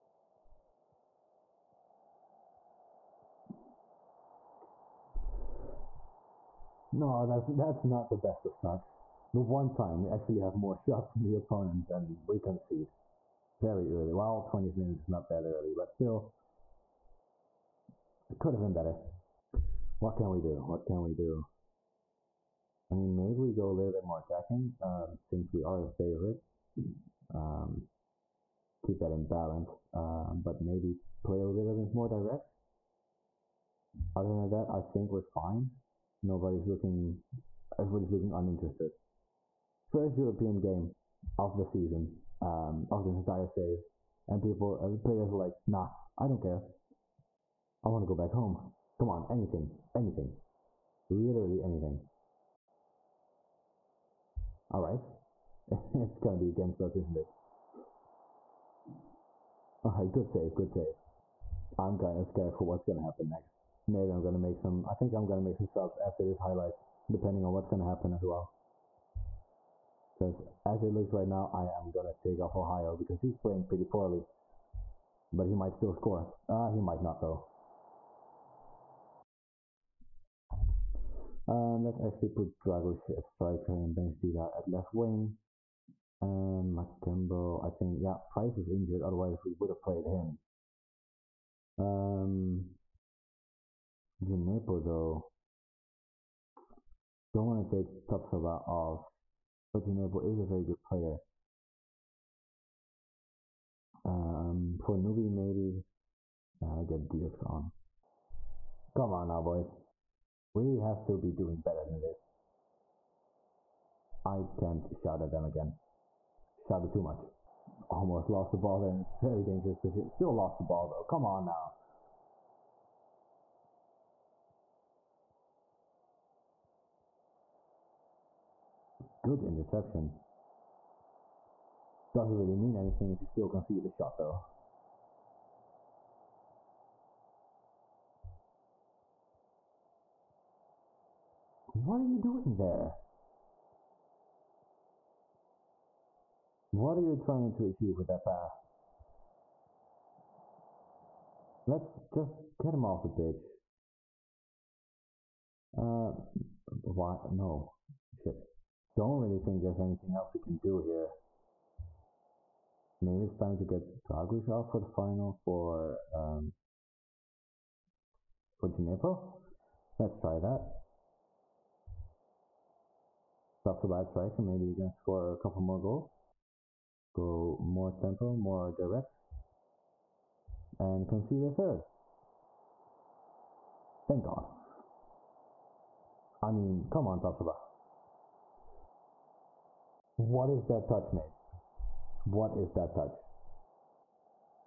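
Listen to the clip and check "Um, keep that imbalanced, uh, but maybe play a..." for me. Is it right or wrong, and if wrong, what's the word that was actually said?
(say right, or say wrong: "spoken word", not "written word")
right.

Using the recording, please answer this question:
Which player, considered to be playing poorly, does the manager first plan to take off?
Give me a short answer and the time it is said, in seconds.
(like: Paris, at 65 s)
Ohio, at 72 s.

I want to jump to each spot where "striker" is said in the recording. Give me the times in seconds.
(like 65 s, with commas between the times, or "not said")
83 s, 174 s.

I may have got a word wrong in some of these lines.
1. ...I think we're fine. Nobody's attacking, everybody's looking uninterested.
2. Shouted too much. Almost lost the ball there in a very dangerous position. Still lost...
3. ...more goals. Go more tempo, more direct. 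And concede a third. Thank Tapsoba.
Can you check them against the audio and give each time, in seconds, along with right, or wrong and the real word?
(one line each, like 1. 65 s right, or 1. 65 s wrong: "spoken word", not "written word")
1. 34 s wrong: "looking", not "attacking"
2. 116 s right
3. 175 s wrong: "God", not "Tapsoba".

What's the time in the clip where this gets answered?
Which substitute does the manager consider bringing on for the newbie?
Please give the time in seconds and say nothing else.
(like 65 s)
107 s.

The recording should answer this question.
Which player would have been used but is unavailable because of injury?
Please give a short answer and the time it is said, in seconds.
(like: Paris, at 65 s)
Price, at 88 s.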